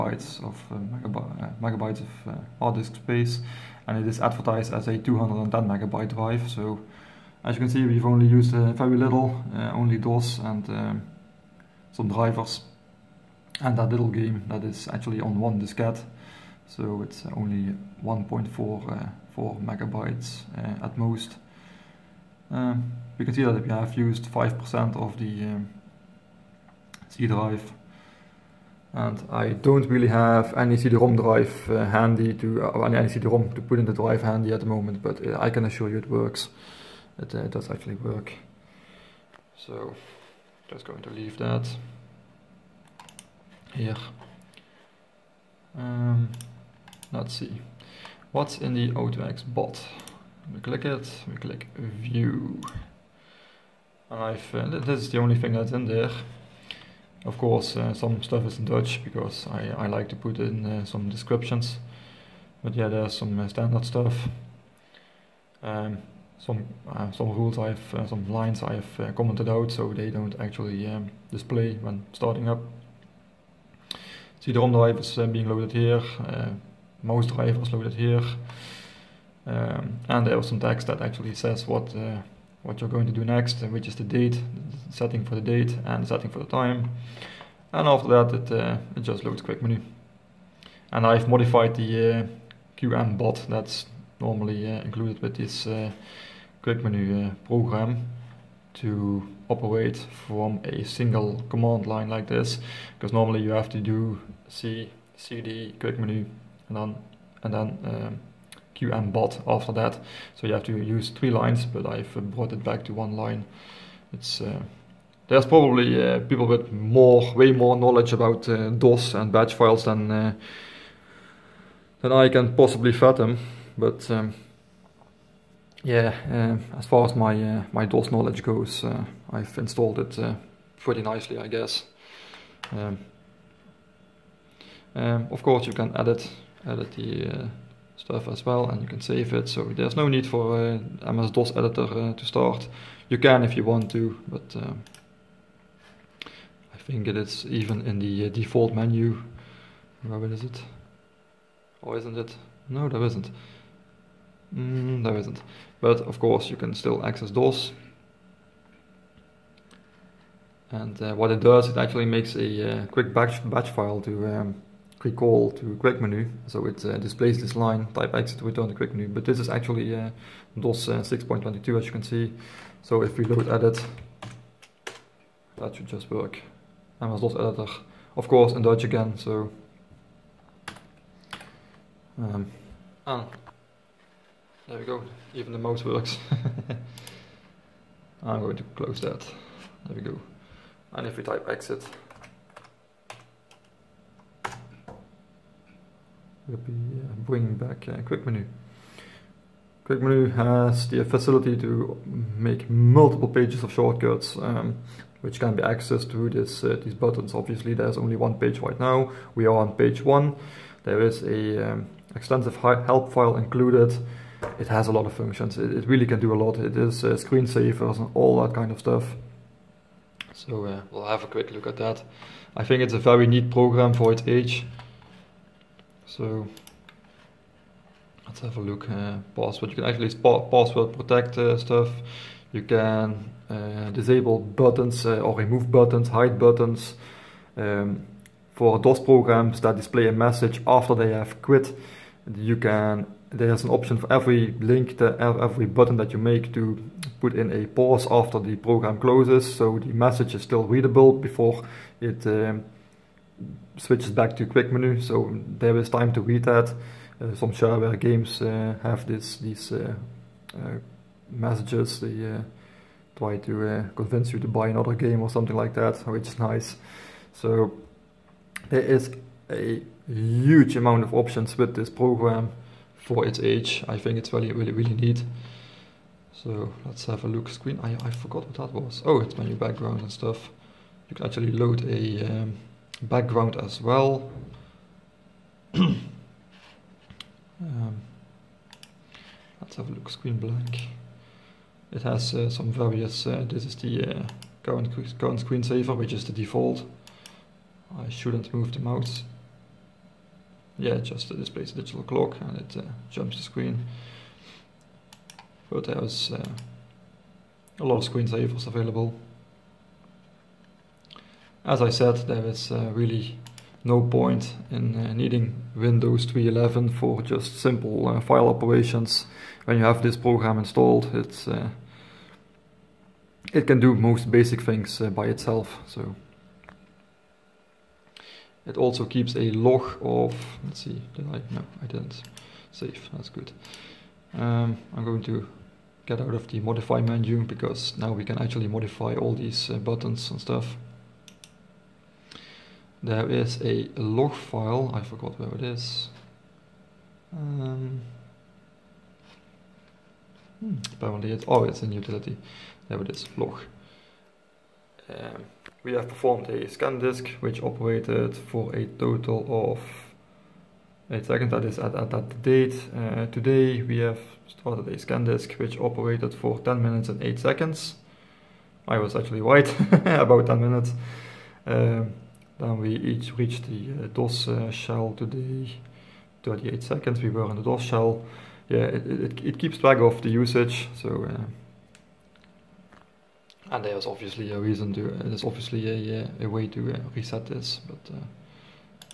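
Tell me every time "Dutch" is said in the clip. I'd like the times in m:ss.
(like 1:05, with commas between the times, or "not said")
0:58, 2:58.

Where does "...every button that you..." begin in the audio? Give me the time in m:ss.
4:05.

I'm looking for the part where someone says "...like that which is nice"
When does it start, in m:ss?
4:25.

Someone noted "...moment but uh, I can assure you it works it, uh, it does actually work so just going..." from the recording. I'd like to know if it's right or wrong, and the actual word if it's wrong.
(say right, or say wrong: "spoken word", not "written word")
right.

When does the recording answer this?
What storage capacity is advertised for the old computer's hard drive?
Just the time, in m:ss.
0:04.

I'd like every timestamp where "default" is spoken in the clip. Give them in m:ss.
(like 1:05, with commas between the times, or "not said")
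2:28, 4:56.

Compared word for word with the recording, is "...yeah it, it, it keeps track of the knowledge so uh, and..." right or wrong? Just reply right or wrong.
wrong.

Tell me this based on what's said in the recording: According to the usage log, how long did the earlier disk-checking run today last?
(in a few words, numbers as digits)
10 minutes 8 seconds.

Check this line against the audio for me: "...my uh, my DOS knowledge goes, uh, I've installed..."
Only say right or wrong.
right.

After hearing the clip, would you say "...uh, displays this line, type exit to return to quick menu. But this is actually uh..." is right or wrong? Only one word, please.
right.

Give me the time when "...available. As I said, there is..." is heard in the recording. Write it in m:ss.
5:08.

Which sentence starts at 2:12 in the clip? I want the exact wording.
Um, um, of course, you can edit edit the uh, stuff as well, and you can save it.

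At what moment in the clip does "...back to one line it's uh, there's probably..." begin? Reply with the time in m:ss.
1:52.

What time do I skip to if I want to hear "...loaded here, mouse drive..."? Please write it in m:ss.
1:15.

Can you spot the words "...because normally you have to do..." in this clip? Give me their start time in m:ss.
1:42.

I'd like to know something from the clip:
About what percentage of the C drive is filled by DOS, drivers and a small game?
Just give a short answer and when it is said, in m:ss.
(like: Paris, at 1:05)
5%, at 0:24.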